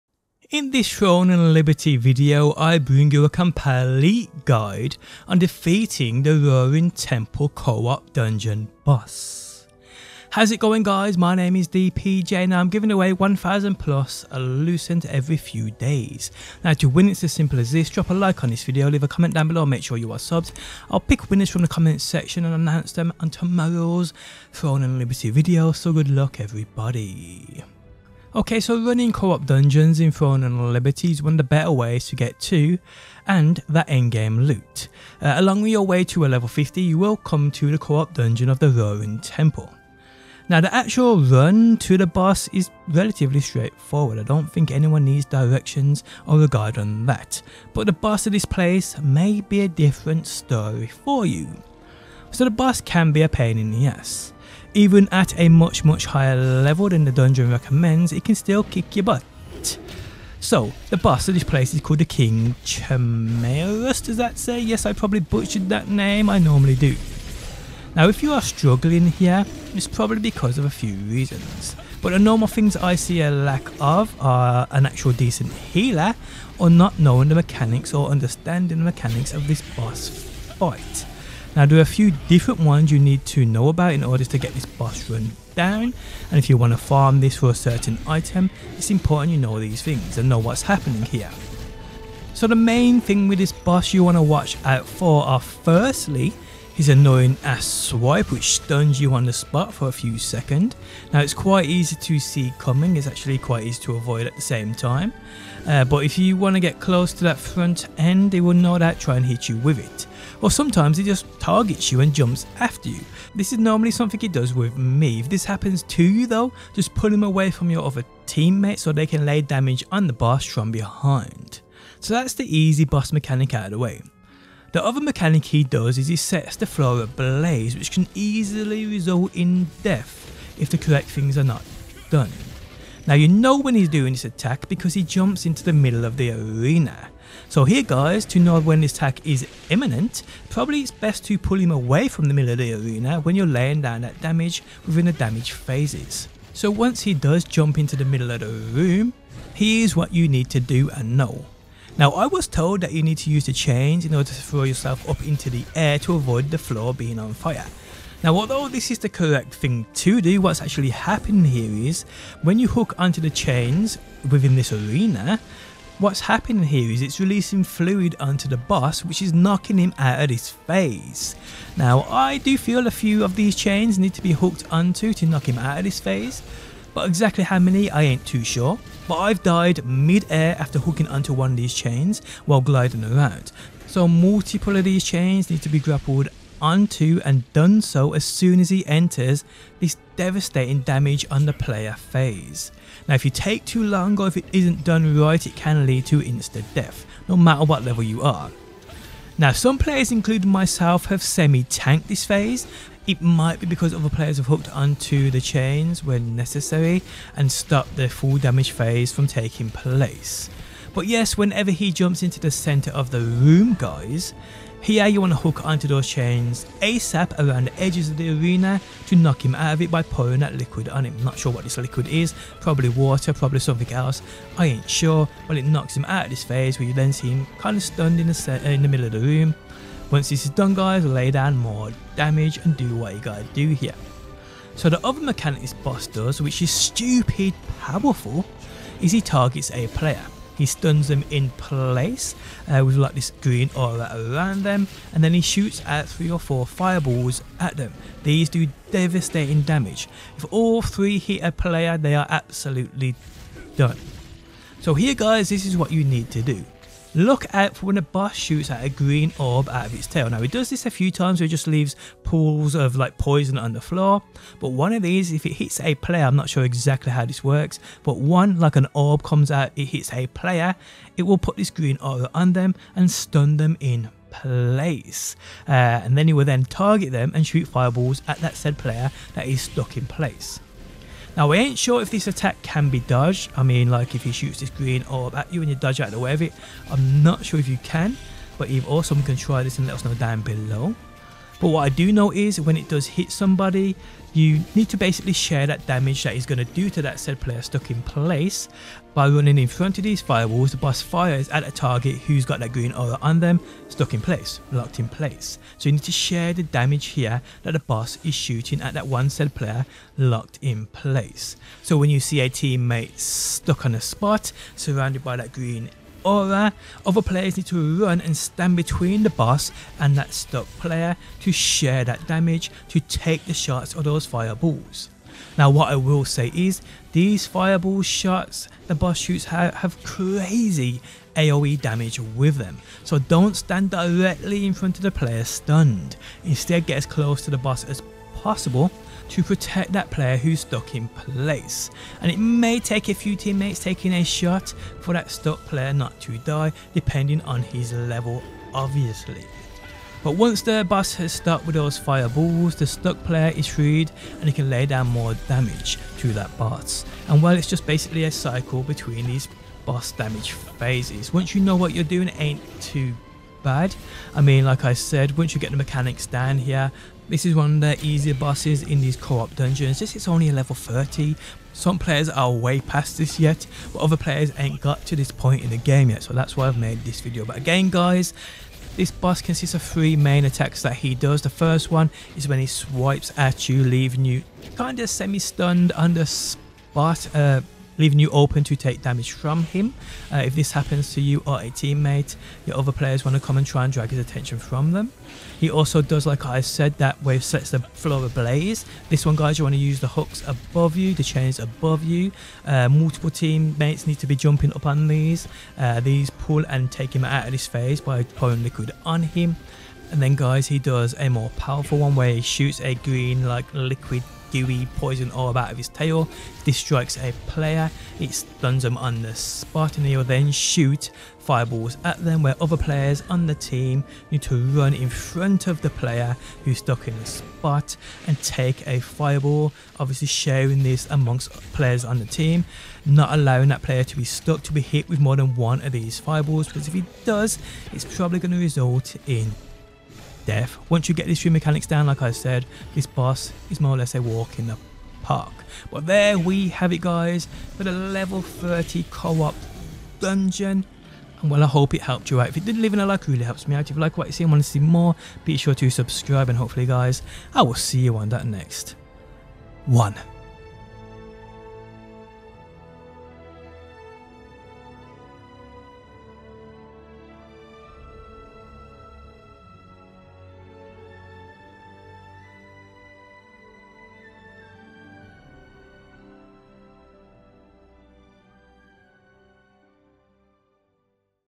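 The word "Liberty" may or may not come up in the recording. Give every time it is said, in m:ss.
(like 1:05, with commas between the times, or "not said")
0:01, 0:24, 0:30.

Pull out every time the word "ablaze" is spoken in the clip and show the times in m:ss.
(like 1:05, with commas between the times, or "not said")
2:07, 6:38.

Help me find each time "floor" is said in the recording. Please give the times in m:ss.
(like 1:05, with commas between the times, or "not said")
2:06, 2:36, 4:23, 6:37.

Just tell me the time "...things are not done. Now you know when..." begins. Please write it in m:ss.
2:11.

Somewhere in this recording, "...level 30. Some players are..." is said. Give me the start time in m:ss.
6:10.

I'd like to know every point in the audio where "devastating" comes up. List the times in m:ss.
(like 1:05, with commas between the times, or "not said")
3:10, 4:08.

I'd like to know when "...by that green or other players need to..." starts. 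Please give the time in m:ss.
5:15.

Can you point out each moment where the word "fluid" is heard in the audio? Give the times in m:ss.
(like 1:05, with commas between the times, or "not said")
2:47.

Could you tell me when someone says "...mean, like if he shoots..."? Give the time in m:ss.
4:43.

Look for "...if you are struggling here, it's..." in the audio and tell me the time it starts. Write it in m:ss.
1:08.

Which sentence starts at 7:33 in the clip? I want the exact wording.
If you like what you see and want to see more, be sure to subscribe.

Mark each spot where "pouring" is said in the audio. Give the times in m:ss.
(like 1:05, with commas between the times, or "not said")
3:40, 6:48.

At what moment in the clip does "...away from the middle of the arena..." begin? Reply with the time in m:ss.
2:21.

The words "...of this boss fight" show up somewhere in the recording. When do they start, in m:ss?
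1:19.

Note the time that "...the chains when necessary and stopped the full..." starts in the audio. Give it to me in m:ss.
3:25.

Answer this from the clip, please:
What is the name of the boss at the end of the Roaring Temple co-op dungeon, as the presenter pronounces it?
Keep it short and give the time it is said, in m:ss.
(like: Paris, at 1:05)
King Chimaerus, at 1:02.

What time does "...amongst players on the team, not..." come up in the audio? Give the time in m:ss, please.
7:11.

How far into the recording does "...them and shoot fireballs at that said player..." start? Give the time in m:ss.
4:37.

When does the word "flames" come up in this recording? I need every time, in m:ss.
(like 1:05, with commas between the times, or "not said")
not said.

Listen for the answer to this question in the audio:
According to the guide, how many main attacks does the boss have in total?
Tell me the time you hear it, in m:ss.
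6:19.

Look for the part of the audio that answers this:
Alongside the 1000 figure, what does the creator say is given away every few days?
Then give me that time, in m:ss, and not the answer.
0:14.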